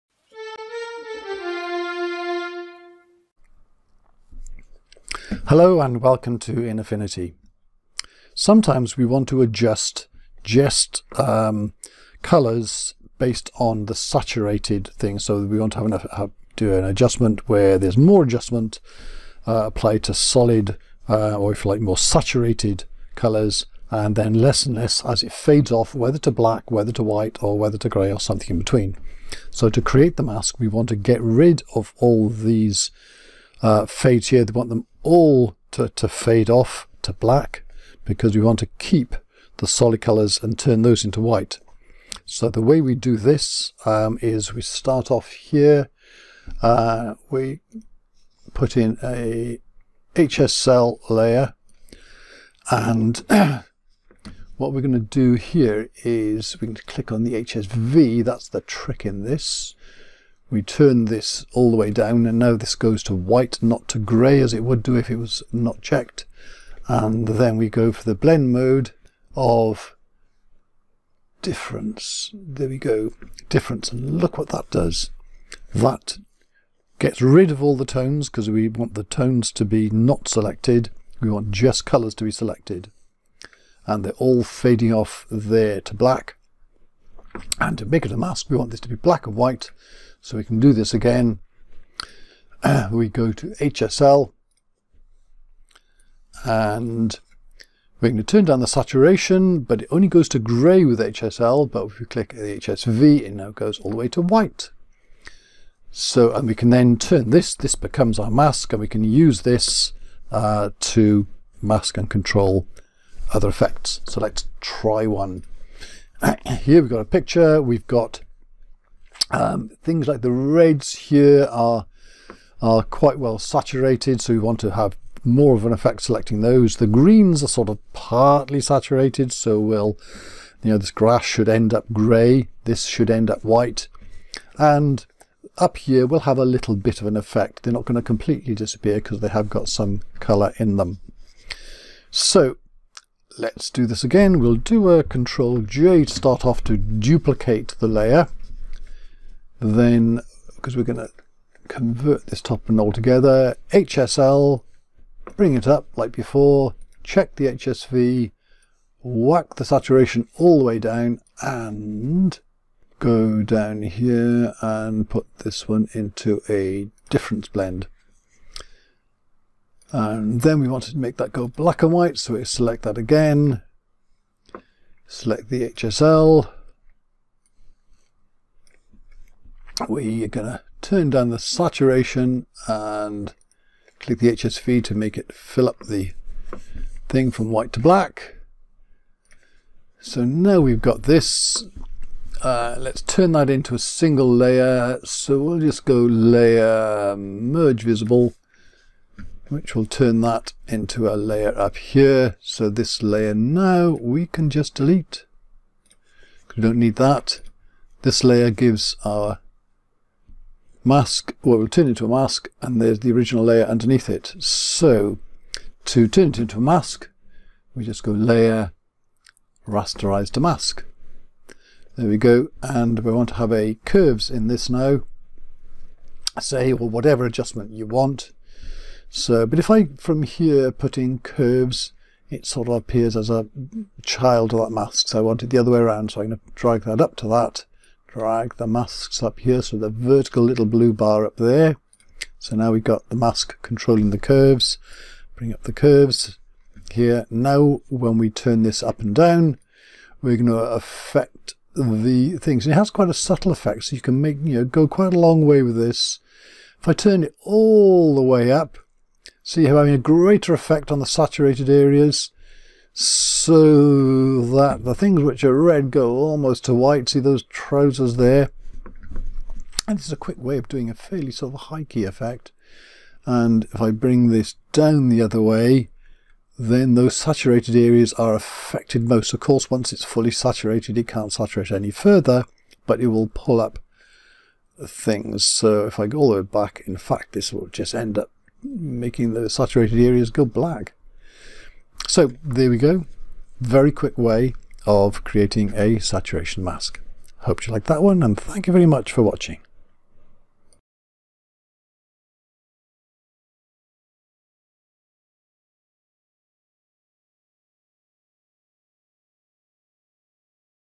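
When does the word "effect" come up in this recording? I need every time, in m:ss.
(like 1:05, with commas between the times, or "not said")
1:53, 2:05, 2:17, 4:13, 4:20, 4:32.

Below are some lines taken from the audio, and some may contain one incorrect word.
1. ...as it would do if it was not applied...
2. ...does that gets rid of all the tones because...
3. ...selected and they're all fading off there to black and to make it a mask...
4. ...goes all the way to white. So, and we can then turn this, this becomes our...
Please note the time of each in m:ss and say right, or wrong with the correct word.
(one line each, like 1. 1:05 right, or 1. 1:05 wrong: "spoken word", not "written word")
1. 1:04 wrong: "checked", not "applied"
2. 1:14 right
3. 1:22 right
4. 1:43 right.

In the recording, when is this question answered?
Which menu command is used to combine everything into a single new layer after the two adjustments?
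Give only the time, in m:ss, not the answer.
3:17.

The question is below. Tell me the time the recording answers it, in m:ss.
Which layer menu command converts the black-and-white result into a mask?
3:39.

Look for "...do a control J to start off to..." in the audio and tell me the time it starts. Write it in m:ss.
2:24.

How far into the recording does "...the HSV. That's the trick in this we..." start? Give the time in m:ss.
0:57.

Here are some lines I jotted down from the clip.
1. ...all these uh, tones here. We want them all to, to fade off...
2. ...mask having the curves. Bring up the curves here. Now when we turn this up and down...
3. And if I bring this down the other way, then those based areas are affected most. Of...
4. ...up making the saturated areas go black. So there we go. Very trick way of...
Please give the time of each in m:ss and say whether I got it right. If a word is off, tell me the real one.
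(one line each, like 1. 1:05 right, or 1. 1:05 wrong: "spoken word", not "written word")
1. 0:31 wrong: "fades", not "tones"
2. 4:03 wrong: "controlling", not "having"
3. 4:33 wrong: "saturated", not "based"
4. 4:48 wrong: "quick", not "trick".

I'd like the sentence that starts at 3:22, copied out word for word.
So this layer now we can just delete.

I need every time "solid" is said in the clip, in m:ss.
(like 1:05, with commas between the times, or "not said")
0:20, 0:39.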